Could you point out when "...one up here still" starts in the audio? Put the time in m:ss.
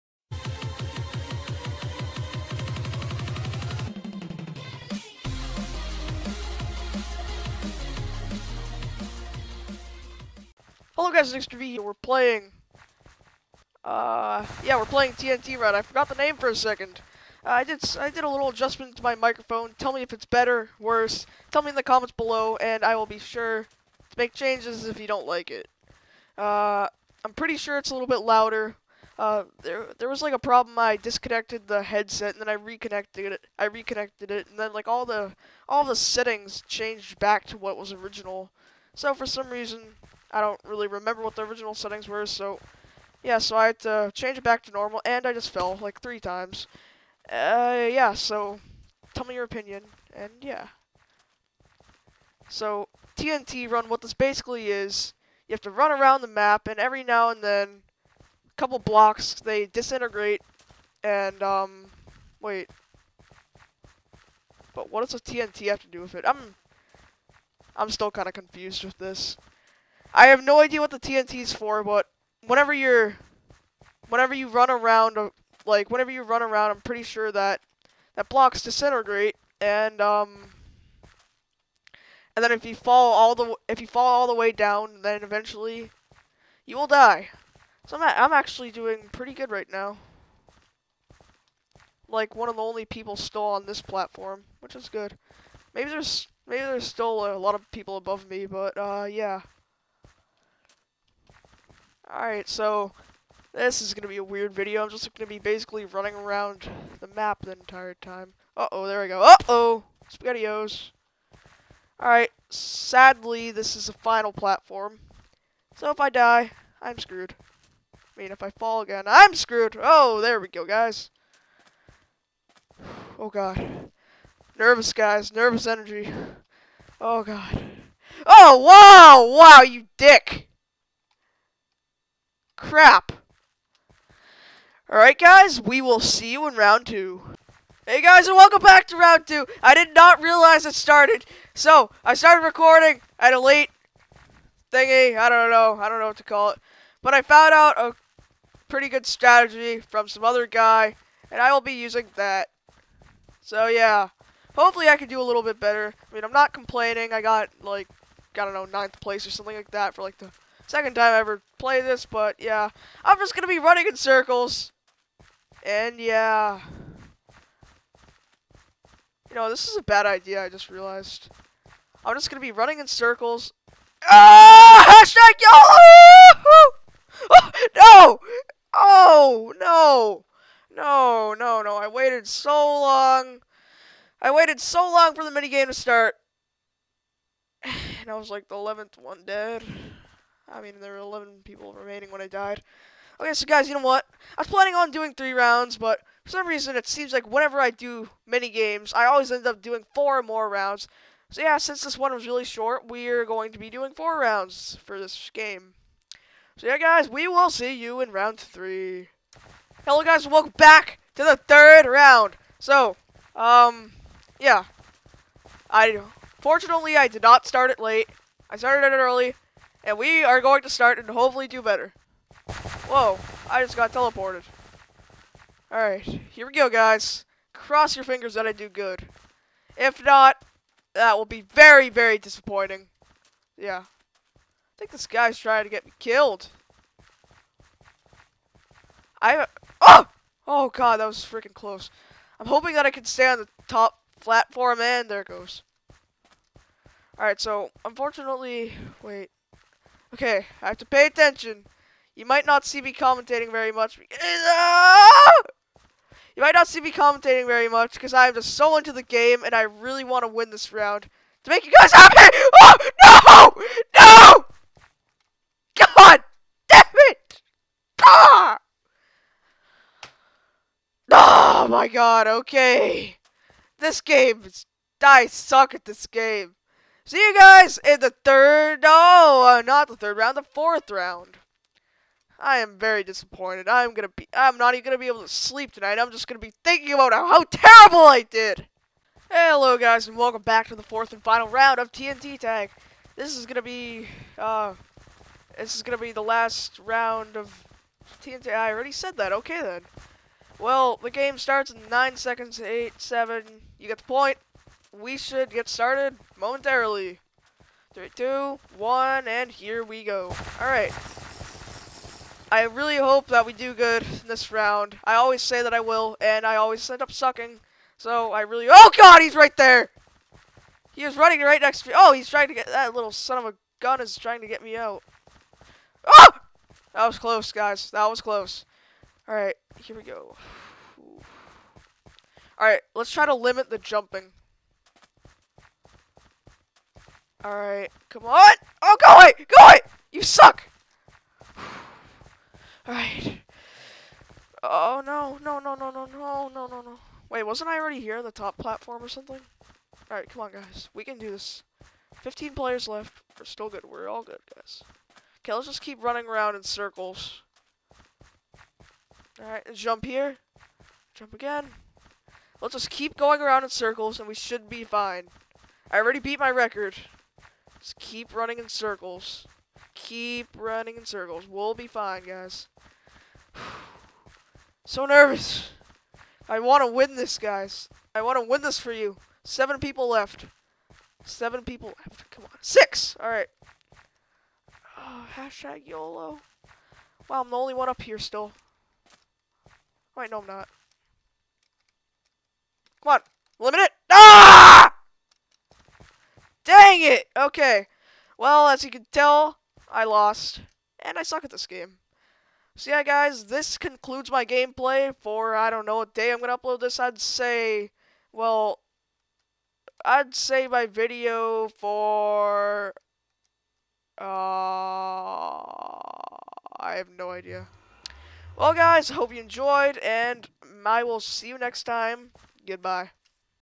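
6:27.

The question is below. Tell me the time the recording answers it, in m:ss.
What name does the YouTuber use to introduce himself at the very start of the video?
0:11.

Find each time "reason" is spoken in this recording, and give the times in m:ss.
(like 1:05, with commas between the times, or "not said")
0:39, 3:16.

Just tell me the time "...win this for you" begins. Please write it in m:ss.
6:18.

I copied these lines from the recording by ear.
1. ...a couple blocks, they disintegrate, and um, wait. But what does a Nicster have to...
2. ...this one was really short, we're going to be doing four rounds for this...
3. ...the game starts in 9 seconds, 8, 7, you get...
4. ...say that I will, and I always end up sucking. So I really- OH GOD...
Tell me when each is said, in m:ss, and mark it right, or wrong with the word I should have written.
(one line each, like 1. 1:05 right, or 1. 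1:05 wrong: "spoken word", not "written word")
1. 0:58 wrong: "TNT", not "Nicster"
2. 3:21 right
3. 5:00 right
4. 5:15 right.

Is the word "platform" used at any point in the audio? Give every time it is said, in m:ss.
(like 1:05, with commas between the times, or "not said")
1:33, 1:54, 4:04, 5:48.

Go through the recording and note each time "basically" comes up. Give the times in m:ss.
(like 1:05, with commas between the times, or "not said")
0:54, 1:45.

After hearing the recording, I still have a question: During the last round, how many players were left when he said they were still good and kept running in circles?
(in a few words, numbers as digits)
15.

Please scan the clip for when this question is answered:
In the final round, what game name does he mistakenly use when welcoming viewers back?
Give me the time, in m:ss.
4:51.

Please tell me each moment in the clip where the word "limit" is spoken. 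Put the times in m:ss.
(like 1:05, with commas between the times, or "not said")
5:33, 6:33.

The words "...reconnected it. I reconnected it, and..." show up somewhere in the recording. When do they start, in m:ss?
0:32.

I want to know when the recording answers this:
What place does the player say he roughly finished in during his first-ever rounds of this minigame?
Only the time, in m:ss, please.
2:38.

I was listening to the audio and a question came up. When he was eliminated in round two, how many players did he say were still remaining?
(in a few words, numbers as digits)
11.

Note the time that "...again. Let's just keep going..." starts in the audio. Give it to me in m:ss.
6:01.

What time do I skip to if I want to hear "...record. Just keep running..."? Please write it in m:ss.
6:06.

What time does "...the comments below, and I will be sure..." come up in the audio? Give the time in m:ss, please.
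0:21.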